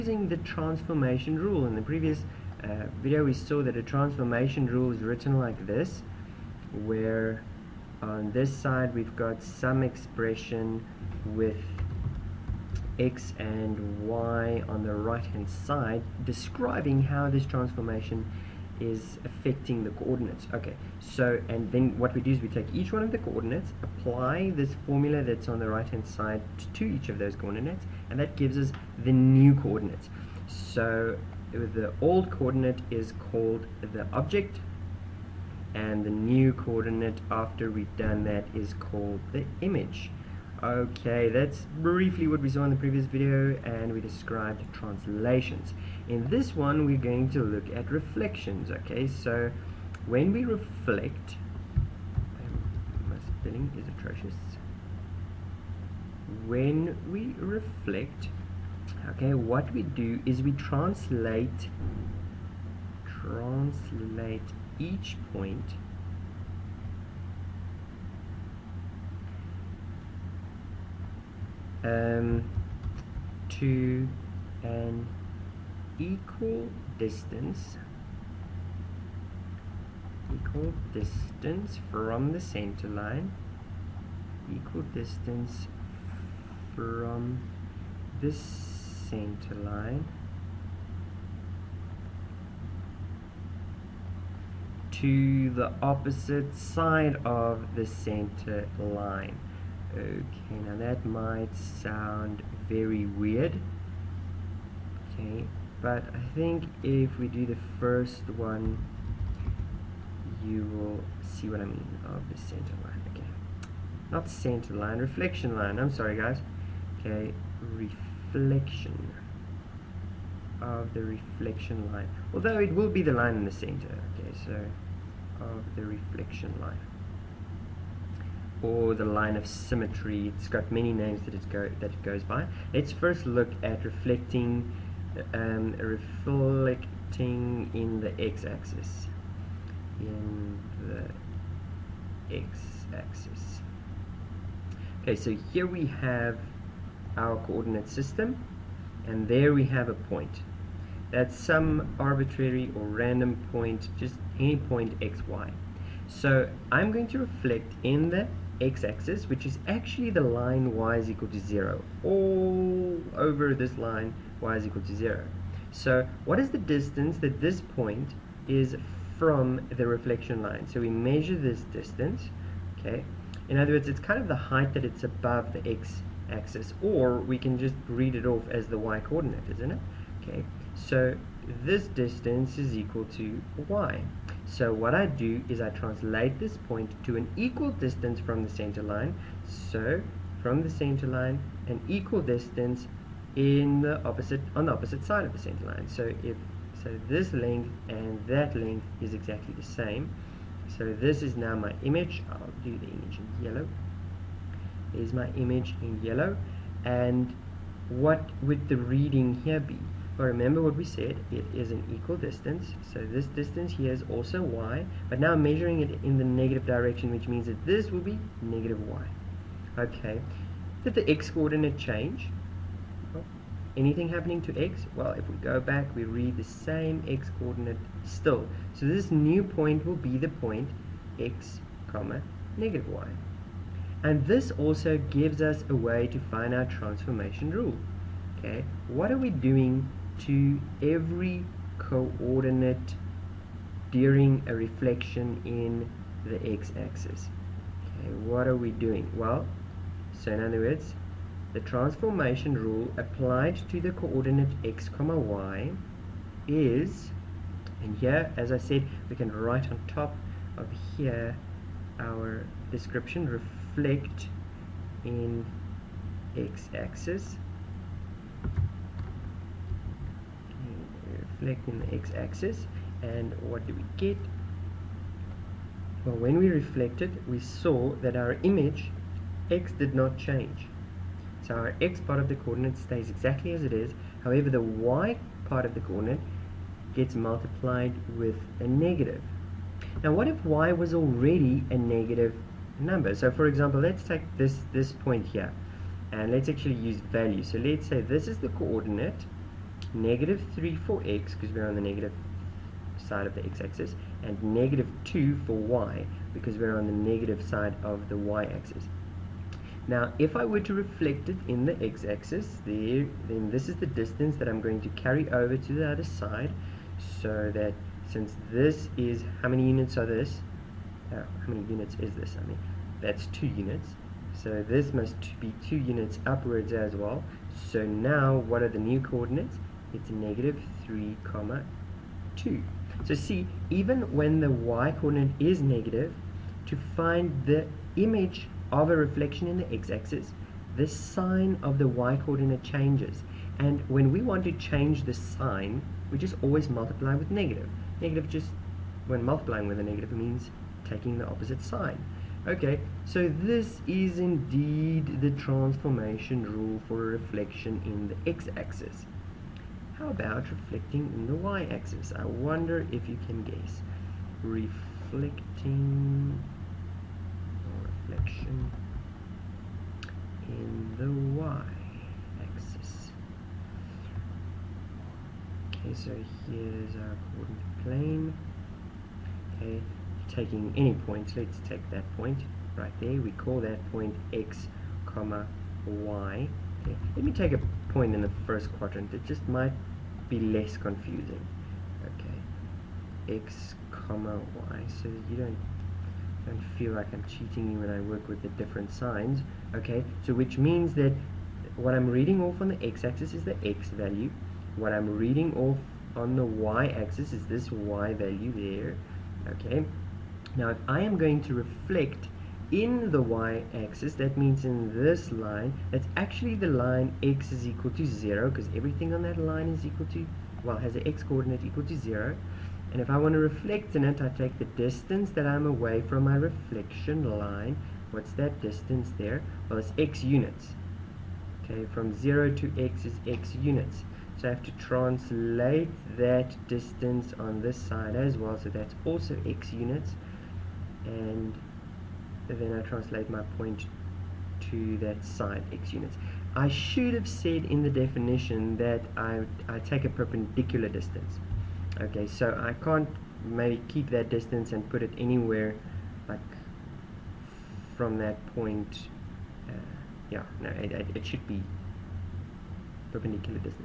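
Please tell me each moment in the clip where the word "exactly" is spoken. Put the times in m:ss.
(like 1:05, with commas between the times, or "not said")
3:19, 4:43.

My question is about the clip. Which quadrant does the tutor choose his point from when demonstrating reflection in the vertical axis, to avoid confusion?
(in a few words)
first quadrant.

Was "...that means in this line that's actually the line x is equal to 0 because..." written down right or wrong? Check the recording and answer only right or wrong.
right.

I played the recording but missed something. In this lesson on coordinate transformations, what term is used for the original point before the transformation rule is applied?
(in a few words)
object.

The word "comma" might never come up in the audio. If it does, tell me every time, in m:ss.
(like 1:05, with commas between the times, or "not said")
3:51, 4:14, 5:31, 6:25, 6:33.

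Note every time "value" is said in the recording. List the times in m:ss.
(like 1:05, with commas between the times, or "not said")
4:56, 6:43, 6:48.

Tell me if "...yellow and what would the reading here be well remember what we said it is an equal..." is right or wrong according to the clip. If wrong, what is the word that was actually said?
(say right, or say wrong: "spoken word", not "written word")
right.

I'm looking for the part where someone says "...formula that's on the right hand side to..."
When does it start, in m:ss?
0:24.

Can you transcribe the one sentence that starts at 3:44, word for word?
Well, if we go back, we read the same x coordinate still.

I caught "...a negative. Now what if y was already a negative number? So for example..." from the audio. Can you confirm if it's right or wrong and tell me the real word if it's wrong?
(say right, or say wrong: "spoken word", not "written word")
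right.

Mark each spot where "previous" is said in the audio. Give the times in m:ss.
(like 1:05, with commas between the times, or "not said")
0:01, 0:42.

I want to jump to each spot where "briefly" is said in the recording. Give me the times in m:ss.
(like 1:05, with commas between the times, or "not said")
0:41.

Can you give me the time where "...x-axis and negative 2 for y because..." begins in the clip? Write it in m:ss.
5:03.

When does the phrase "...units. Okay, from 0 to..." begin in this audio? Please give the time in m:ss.
7:10.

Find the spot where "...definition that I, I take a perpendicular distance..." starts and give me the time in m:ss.
7:27.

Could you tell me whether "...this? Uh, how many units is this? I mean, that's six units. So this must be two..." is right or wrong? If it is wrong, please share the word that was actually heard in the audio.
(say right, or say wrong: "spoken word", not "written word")
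wrong: "two", not "six".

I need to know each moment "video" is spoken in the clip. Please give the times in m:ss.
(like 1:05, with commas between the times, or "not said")
0:03, 0:43.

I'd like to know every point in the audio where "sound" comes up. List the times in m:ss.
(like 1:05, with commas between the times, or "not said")
1:41.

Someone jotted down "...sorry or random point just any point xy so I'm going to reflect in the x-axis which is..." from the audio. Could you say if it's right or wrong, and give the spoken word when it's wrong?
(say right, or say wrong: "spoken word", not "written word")
wrong: "arbitrary", not "sorry".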